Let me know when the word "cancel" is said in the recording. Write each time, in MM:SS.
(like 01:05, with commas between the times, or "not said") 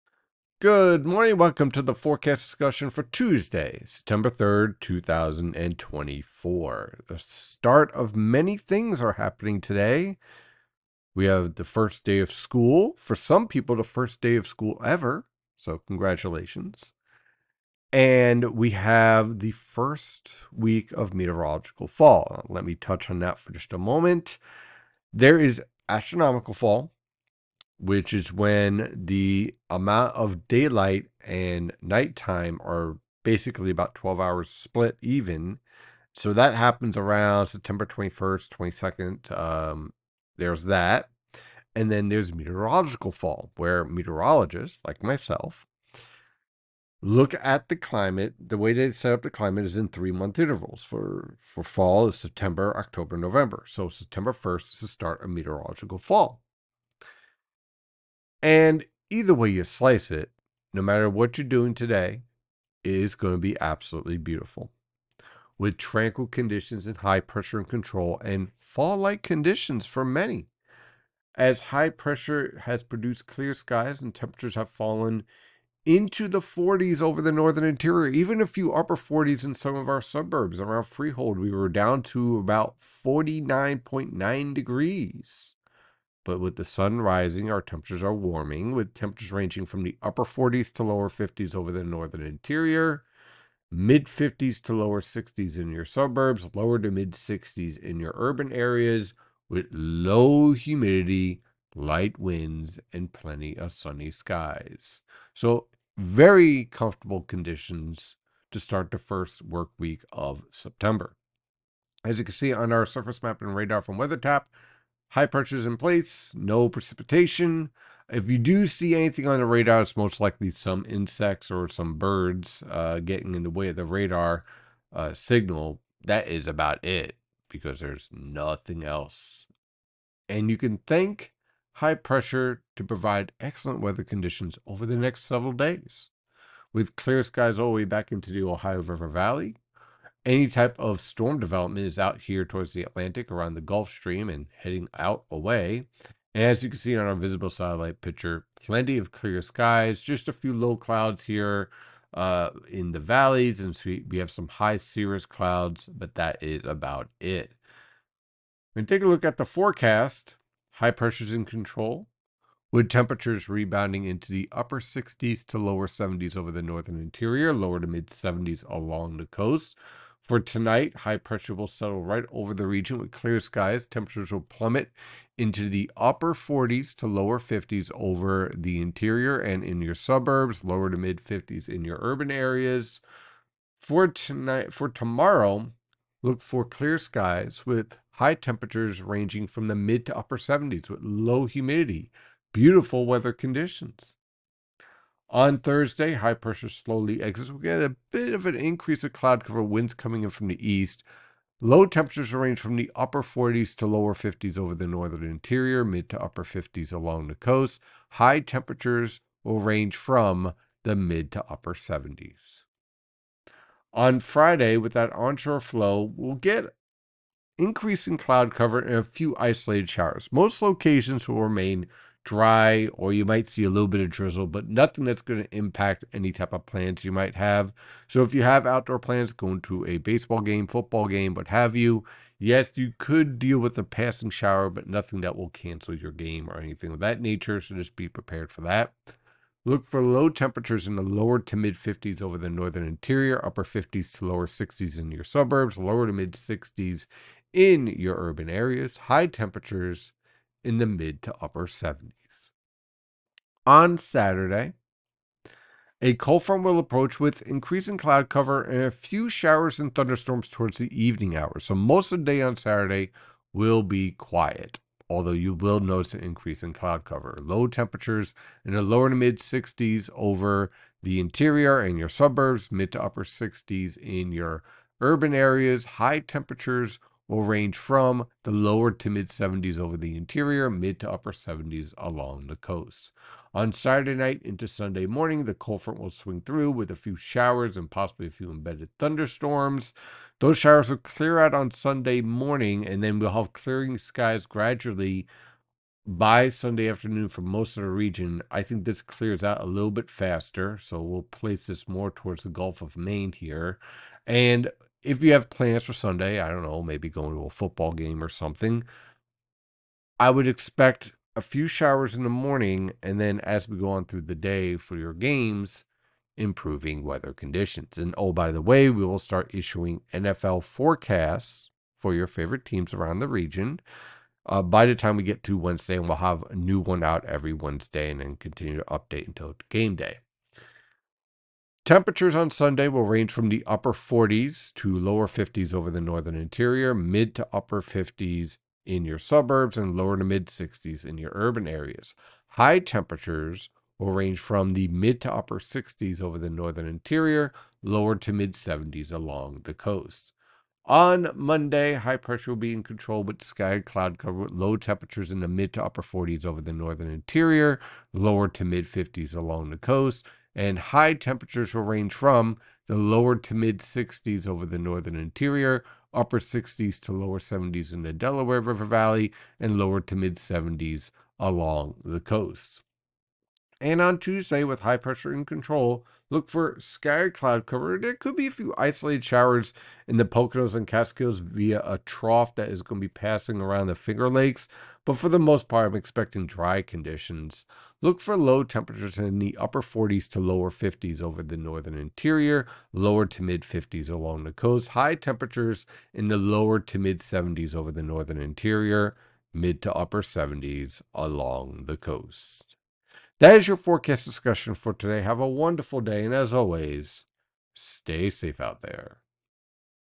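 03:55.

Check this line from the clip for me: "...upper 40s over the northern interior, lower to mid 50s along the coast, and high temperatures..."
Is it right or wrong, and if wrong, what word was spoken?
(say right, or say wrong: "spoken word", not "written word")
right.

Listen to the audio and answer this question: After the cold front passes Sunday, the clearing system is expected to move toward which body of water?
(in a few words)
Gulf of Maine.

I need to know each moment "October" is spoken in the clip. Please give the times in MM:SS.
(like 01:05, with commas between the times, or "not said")
00:52.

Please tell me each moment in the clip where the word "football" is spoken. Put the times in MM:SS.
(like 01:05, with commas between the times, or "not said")
03:50, 05:07.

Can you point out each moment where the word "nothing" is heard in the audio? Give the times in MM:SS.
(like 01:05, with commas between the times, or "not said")
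02:08, 03:44, 03:54.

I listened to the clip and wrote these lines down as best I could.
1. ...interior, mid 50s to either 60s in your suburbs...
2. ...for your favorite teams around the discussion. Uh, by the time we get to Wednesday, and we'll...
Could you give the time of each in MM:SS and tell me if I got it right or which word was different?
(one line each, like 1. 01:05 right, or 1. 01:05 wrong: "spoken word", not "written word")
1. 01:32 wrong: "lower", not "either"
2. 05:21 wrong: "region", not "discussion".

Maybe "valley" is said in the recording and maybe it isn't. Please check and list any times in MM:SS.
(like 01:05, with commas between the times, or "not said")
02:19, 02:32, 06:08.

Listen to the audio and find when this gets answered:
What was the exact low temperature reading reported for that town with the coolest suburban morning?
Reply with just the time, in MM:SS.
01:23.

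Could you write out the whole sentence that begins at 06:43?
That is your forecast discussion for today.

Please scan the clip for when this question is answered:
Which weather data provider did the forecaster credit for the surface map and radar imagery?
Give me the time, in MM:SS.
01:53.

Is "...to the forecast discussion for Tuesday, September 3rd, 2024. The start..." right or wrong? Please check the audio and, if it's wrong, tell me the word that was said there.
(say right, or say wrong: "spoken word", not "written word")
right.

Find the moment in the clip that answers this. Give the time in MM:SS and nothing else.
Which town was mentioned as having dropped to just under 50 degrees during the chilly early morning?
01:20.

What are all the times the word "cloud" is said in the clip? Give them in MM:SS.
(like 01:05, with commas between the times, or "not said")
02:30, 02:35, 03:19, 03:38, 04:17, 04:26, 05:53, 06:17.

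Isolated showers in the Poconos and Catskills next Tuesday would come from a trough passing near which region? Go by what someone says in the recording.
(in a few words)
Finger Lakes.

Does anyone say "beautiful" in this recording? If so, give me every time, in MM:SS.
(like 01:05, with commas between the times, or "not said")
01:04, 03:12.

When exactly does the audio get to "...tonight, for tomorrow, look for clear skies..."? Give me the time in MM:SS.
03:04.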